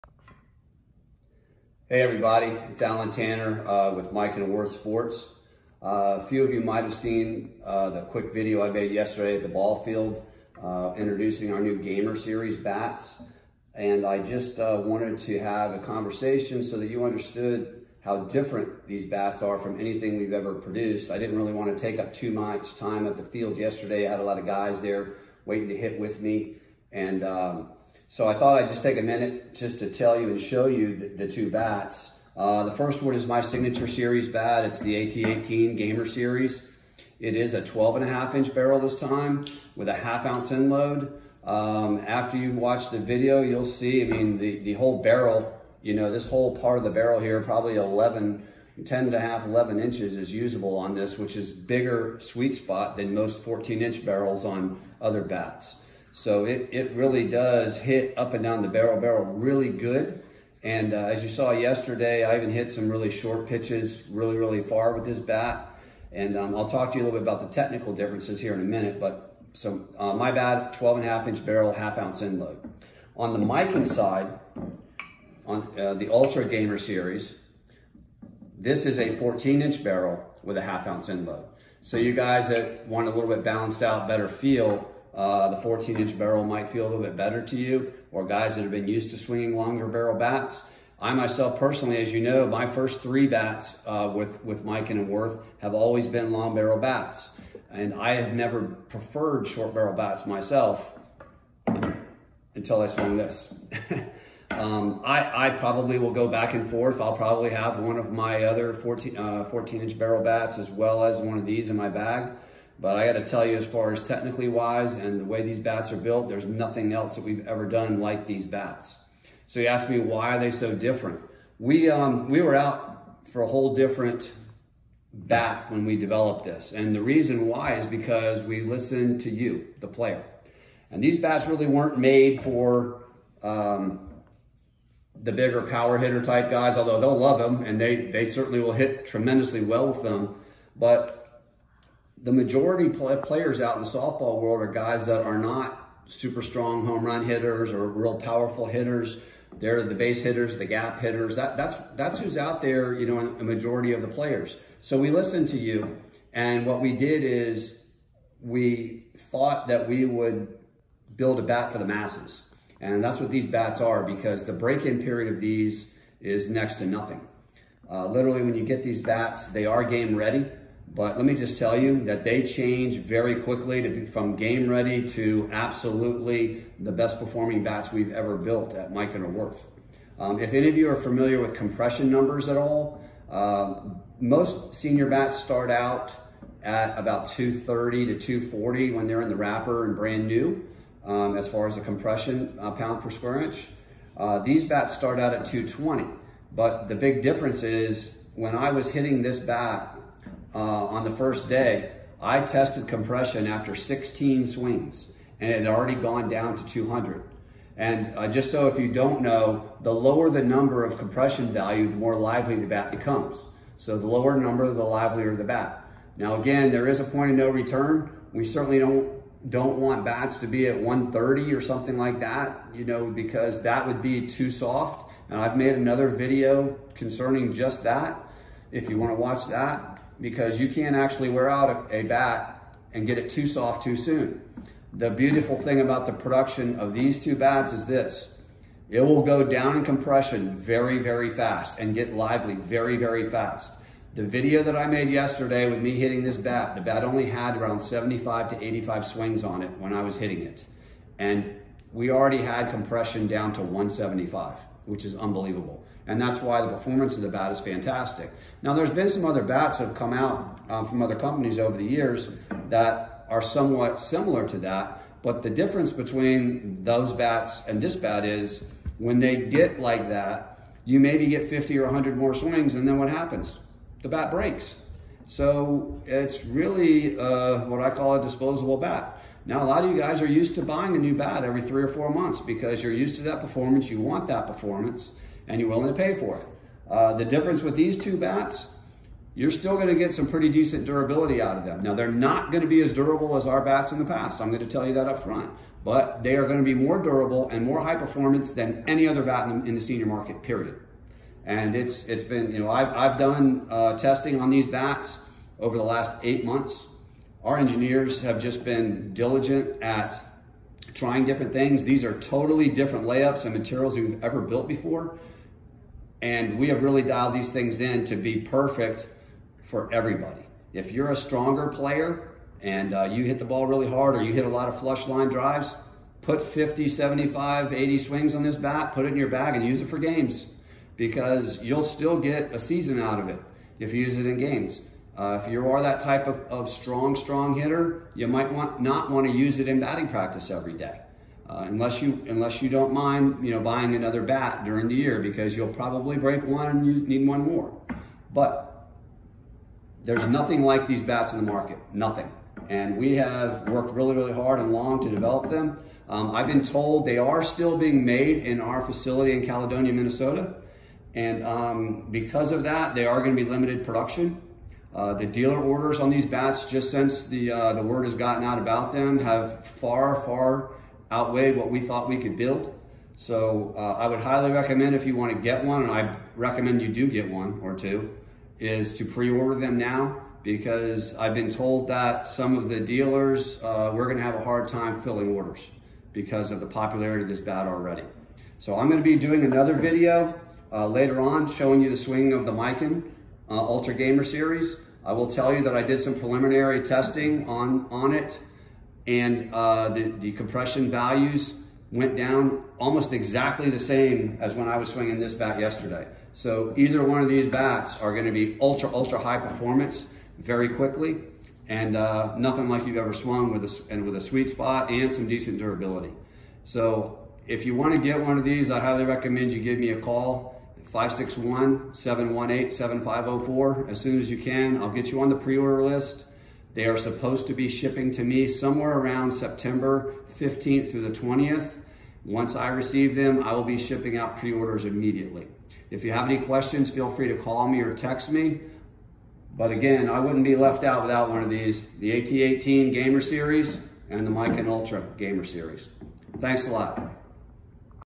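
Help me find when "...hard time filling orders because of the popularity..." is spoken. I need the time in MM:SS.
06:24.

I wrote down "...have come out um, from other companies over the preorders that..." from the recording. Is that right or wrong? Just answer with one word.
wrong.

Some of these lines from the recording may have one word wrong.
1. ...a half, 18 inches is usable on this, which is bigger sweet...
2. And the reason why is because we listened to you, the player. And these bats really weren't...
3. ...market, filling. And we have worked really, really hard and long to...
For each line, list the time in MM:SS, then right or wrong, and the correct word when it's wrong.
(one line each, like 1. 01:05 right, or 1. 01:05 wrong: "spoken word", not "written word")
1. 00:49 wrong: "11", not "18"
2. 02:06 right
3. 05:51 wrong: "nothing", not "filling".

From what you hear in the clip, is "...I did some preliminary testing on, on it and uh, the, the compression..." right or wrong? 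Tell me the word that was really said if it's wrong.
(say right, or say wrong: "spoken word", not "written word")
right.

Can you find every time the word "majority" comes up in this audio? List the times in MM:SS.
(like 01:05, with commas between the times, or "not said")
02:22, 02:33.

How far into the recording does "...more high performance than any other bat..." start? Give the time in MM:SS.
04:57.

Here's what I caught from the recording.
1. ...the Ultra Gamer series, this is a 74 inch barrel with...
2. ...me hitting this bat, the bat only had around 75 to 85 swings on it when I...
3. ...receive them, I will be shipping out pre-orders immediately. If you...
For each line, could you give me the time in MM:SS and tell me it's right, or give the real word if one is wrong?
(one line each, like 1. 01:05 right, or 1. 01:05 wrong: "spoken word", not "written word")
1. 01:15 wrong: "14", not "74"
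2. 04:05 right
3. 07:12 right.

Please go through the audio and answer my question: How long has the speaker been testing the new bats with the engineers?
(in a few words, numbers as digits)
8 months.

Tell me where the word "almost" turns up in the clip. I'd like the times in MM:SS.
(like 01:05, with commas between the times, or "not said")
06:42.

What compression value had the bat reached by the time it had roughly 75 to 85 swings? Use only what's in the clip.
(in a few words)
175.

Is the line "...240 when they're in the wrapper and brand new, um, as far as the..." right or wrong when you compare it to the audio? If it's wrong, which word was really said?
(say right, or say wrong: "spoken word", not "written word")
right.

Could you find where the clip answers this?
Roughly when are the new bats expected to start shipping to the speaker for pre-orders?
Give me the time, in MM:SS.
07:09.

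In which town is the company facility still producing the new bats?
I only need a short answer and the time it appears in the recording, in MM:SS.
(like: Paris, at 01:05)
Caledonia, Minnesota, at 05:59.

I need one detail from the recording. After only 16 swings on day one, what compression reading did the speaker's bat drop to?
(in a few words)
200.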